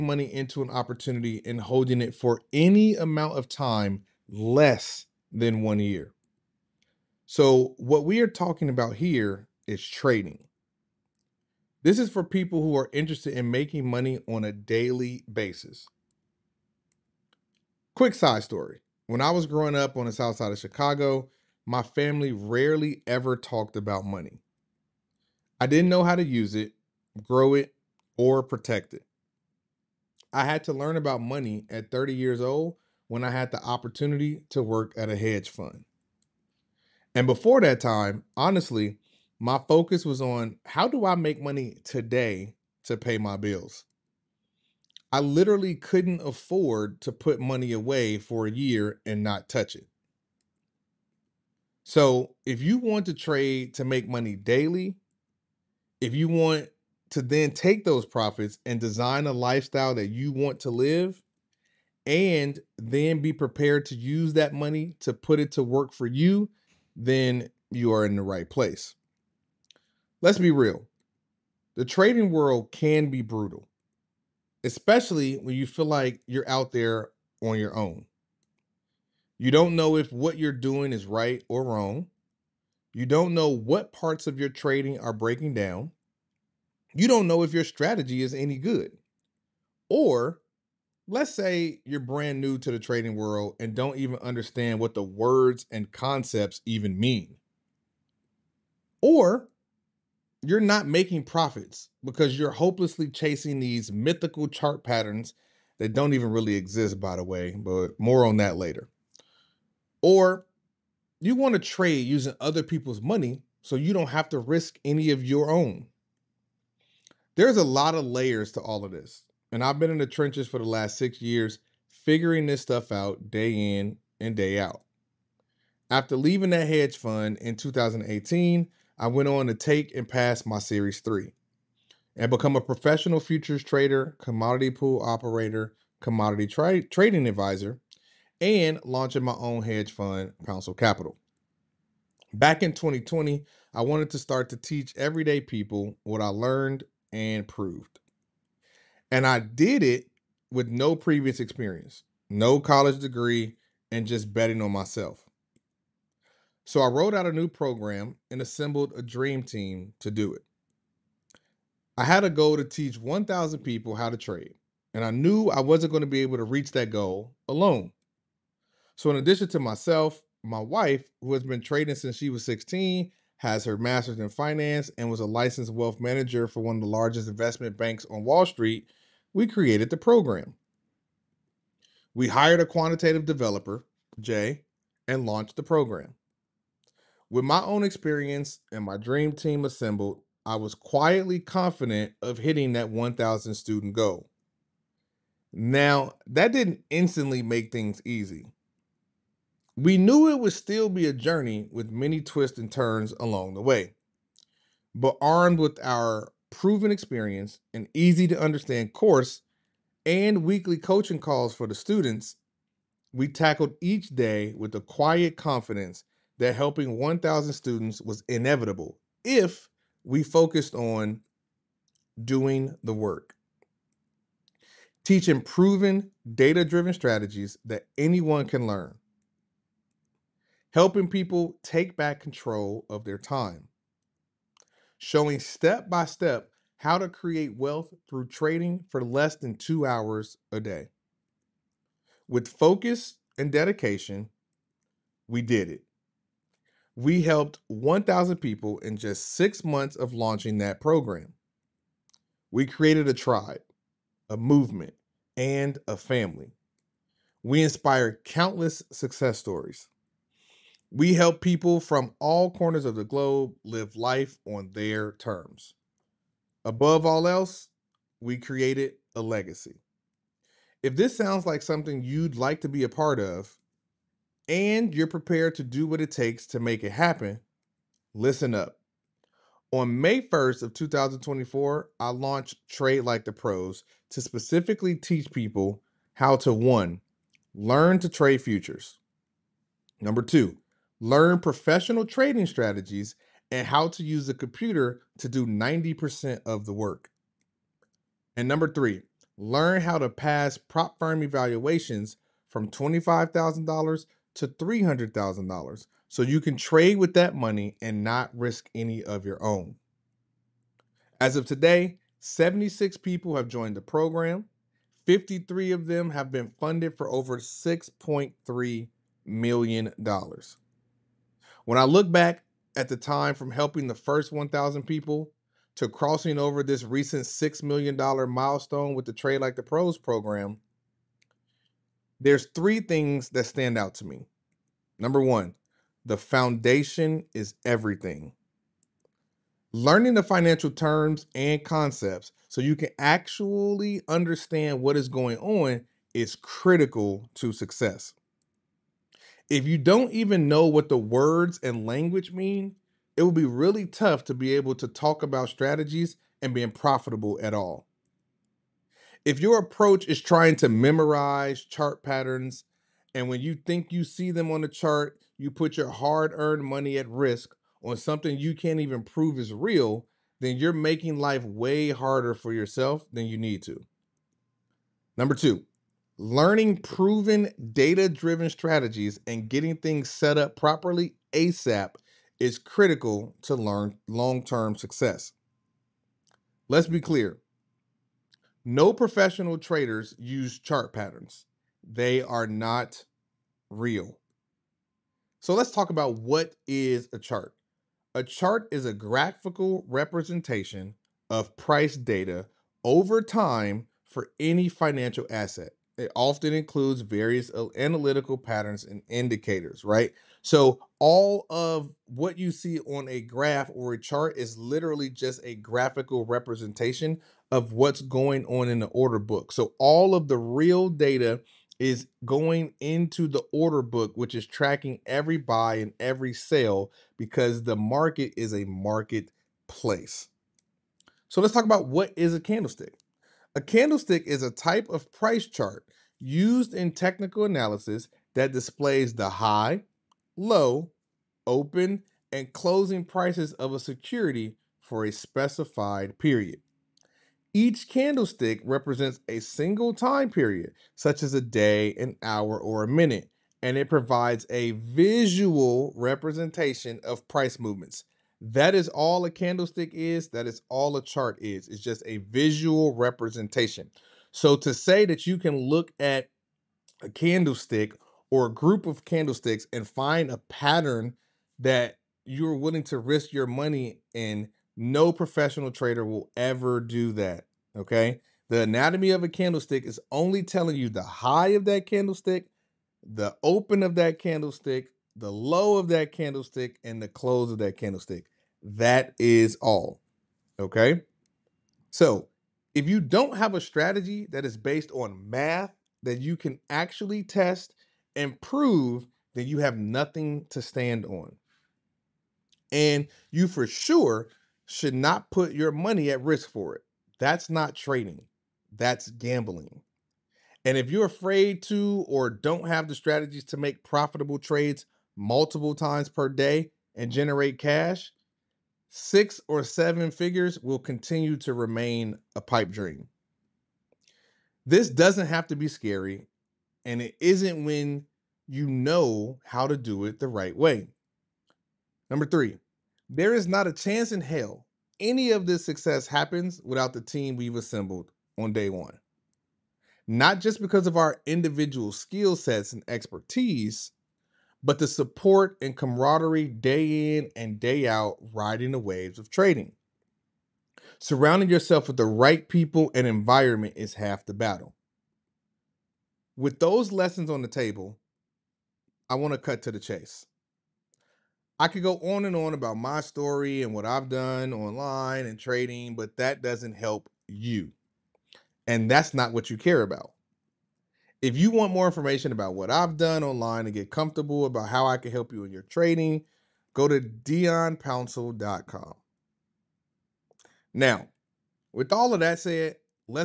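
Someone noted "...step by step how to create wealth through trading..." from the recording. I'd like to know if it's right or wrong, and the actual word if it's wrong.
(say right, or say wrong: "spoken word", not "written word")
right.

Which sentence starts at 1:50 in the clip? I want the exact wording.
Or you want to trade using other people's money so you don't have to risk any of your own.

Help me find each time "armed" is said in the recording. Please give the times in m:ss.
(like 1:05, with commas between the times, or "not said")
3:25.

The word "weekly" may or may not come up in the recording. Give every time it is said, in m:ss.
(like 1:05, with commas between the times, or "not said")
3:30.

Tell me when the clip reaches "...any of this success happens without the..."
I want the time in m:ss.
8:55.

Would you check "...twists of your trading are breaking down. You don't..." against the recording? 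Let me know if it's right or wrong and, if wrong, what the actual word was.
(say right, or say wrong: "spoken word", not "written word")
wrong: "parts", not "twists".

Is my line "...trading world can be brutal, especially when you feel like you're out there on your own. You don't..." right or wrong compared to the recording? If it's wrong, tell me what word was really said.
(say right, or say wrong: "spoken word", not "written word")
right.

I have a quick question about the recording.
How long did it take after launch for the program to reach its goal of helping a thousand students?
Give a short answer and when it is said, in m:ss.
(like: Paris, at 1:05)
6 months, at 4:09.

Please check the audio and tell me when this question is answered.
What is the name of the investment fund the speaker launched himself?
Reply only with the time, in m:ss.
2:20.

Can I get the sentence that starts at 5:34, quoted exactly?
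Number one, the foundation is everything.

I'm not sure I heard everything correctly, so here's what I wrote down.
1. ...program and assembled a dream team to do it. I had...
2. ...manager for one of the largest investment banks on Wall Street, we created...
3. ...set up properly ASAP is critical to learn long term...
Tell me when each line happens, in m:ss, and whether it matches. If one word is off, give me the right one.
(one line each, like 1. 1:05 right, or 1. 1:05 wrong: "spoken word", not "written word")
1. 2:37 right
2. 2:55 right
3. 6:20 right.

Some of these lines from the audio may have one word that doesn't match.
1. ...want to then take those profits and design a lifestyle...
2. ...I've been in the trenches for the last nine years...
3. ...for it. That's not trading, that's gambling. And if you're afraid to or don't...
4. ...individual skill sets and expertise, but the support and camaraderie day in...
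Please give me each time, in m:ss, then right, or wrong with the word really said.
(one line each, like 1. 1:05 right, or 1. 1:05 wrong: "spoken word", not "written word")
1. 0:56 right
2. 1:59 wrong: "six", not "nine"
3. 8:26 right
4. 9:01 right.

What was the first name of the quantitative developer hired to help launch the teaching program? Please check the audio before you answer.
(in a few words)
Jay.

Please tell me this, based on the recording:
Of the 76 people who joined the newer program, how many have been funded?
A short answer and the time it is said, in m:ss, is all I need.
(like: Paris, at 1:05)
53, at 5:15.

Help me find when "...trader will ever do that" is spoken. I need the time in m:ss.
7:55.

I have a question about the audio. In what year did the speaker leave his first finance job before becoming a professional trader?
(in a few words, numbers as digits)
2018.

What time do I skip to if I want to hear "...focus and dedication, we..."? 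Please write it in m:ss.
4:02.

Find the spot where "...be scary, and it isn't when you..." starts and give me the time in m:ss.
8:45.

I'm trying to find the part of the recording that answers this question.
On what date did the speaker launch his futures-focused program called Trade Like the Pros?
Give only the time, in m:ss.
4:39.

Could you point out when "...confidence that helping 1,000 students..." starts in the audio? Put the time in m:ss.
3:35.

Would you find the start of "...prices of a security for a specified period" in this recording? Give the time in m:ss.
7:23.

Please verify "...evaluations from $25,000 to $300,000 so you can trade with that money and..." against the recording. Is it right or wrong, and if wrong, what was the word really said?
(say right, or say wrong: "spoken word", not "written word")
right.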